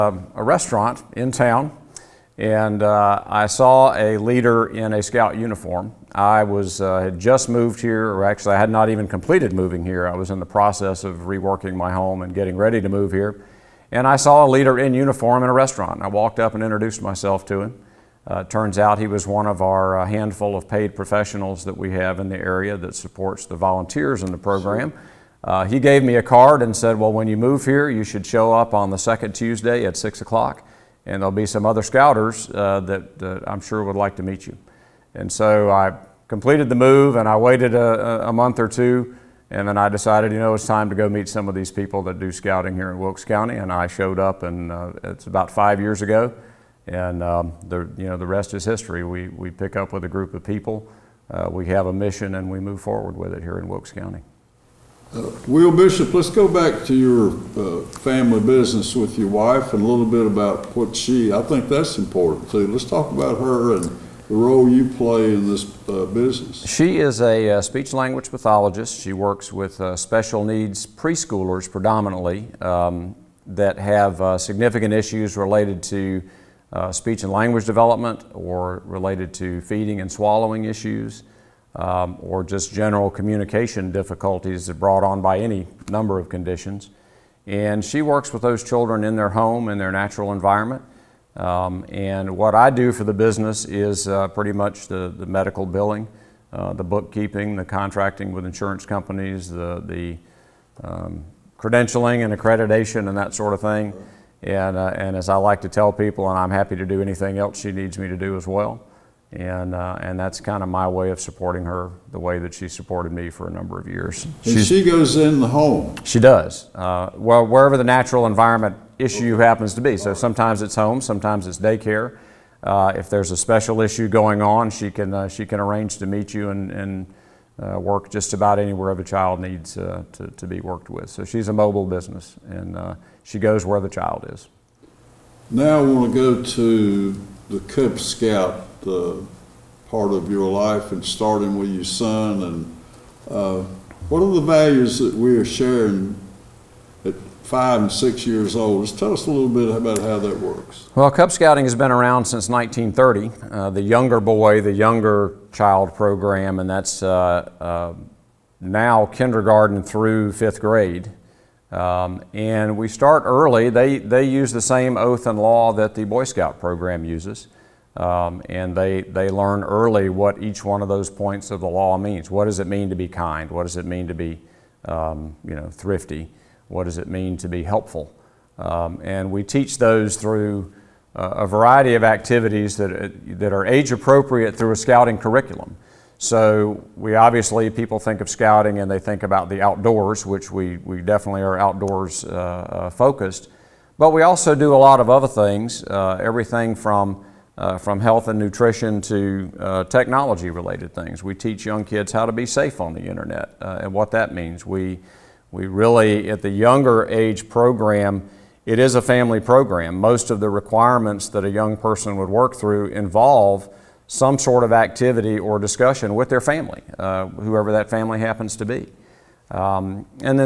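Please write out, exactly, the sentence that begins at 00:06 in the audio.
I was uh, had just moved here, or actually I had not even completed moving here.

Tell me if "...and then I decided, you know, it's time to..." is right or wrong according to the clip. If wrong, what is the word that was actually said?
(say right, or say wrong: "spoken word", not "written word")
right.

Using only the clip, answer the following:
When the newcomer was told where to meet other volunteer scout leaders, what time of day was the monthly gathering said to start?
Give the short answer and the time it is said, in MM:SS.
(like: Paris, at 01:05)
6 o'clock, at 00:29.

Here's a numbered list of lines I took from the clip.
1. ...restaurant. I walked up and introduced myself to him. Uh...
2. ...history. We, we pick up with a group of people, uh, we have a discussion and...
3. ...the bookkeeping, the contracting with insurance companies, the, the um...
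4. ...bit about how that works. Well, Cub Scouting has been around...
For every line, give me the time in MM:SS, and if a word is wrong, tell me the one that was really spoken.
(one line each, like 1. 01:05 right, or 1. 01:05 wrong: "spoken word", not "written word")
1. 00:15 right
2. 00:48 wrong: "mission", not "discussion"
3. 01:36 right
4. 02:29 right.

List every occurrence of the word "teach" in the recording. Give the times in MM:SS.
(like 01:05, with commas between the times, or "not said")
02:59, 03:21.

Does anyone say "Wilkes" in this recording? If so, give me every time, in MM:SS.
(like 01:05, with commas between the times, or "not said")
00:42, 00:53.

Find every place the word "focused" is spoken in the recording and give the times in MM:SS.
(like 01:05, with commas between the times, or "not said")
03:12.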